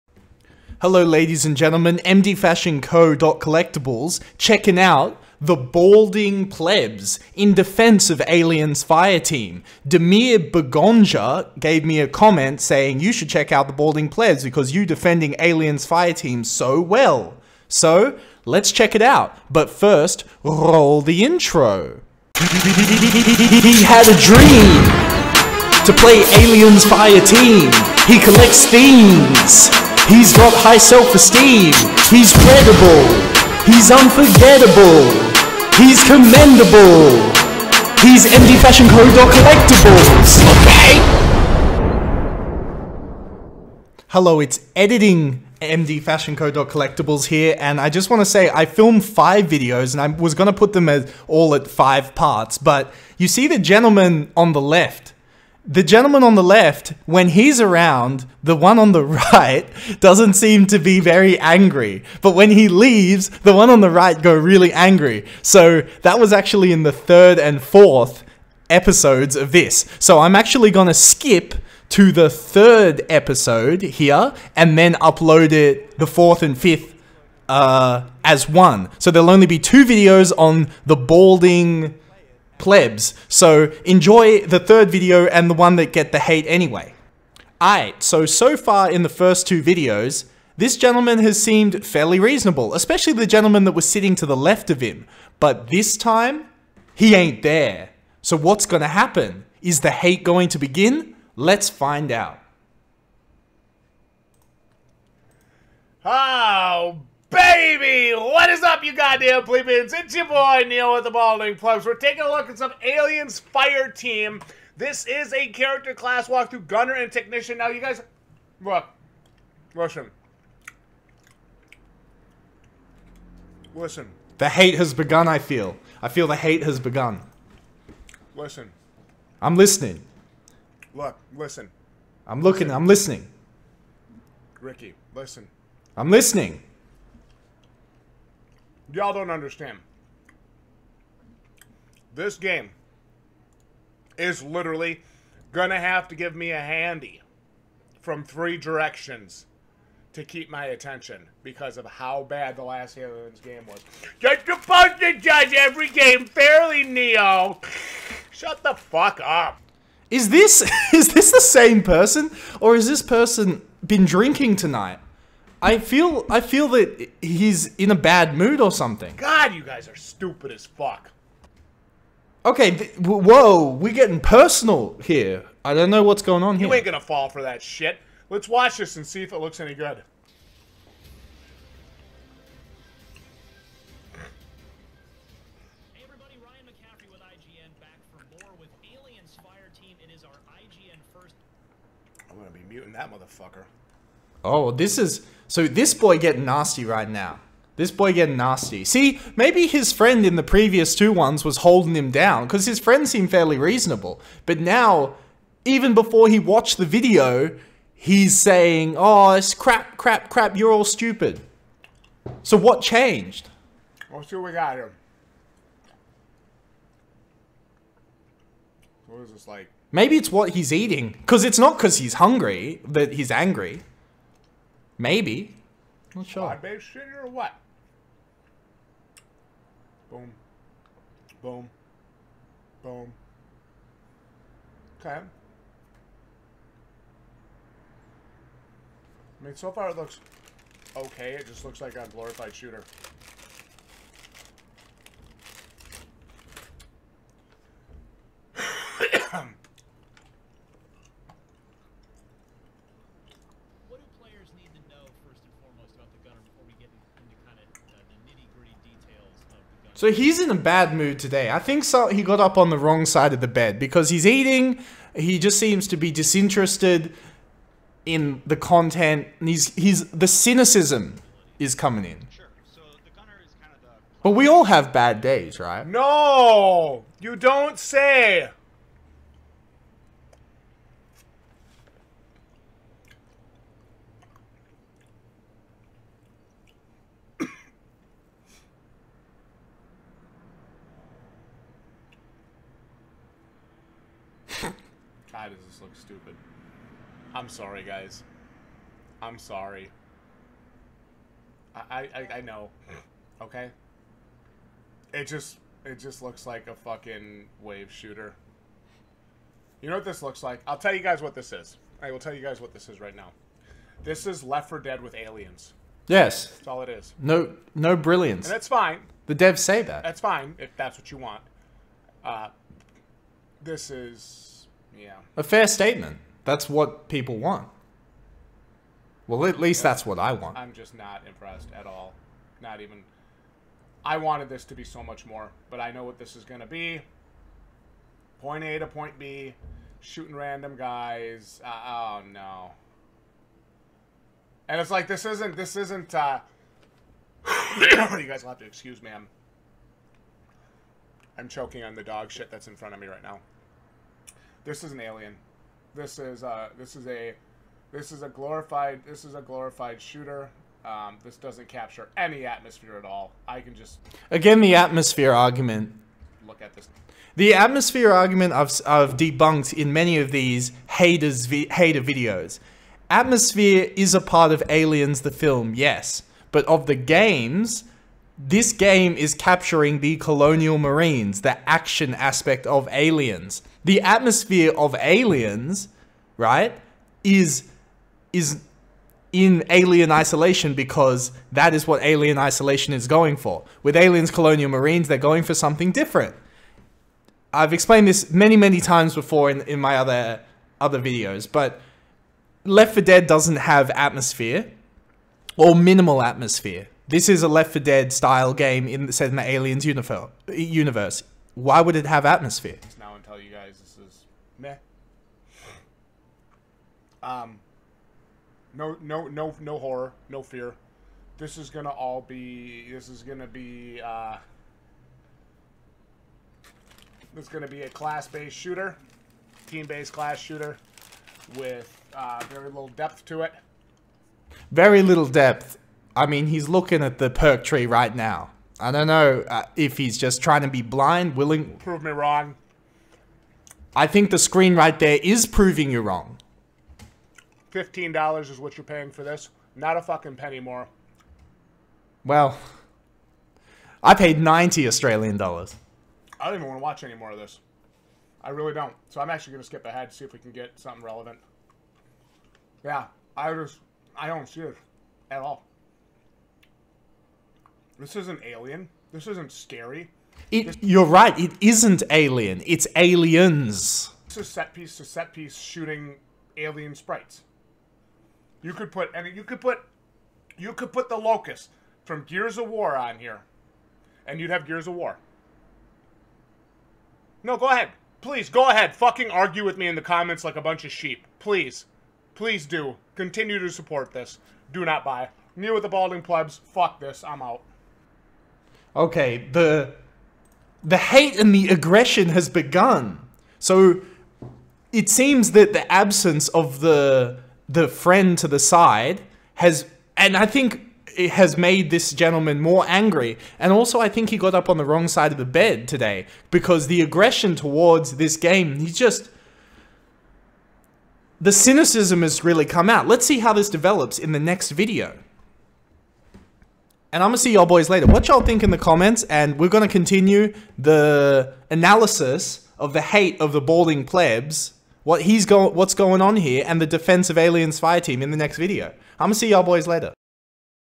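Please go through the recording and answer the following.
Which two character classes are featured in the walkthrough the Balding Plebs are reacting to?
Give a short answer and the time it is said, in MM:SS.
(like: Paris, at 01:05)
gunner and technician, at 01:56.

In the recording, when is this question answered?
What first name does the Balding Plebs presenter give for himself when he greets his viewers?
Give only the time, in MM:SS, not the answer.
01:50.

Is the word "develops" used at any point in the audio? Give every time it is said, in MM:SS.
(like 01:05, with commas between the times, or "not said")
08:43.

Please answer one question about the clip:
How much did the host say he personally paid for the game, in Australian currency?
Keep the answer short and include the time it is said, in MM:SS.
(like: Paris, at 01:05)
90 Australian dollars, at 07:34.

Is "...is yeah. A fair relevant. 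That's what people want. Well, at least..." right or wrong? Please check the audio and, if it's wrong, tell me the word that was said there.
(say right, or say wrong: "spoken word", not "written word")
wrong: "statement", not "relevant".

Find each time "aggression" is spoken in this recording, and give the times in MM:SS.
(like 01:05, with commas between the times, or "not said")
08:21, 08:37.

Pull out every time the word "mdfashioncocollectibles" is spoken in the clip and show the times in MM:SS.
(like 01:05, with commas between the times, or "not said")
00:01.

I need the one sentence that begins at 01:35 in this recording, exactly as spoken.
But this time, he ain't there.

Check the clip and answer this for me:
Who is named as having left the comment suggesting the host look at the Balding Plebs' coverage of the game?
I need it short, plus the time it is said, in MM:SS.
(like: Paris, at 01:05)
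Demir Begonja, at 00:09.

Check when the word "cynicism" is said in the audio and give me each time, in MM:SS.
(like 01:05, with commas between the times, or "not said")
04:30, 08:41.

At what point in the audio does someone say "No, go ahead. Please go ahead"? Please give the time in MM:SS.
08:07.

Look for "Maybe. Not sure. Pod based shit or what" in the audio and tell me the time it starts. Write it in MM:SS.
03:45.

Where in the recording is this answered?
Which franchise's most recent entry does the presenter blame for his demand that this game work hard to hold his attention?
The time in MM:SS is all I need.
02:32.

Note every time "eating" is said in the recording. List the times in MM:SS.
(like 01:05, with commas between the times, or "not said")
03:40, 04:24.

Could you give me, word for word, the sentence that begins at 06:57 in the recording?
Um, no, no, no, no horror, no fear.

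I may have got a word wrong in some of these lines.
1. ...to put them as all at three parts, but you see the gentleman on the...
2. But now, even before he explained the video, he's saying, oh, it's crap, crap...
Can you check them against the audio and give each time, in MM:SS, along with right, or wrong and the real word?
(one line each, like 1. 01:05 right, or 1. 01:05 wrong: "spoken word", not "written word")
1. 00:50 wrong: "five", not "three"
2. 03:24 wrong: "watched", not "explained".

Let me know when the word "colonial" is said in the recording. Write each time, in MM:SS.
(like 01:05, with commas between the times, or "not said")
06:20, 06:34.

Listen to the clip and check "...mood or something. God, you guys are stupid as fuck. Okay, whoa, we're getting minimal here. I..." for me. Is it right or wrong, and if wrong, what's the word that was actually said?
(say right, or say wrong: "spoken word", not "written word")
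wrong: "personal", not "minimal".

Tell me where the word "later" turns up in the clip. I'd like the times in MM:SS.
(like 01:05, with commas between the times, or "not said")
08:47, 08:59.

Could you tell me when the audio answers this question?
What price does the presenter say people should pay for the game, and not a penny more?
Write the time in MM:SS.
07:27.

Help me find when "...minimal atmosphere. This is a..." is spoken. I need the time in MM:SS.
06:45.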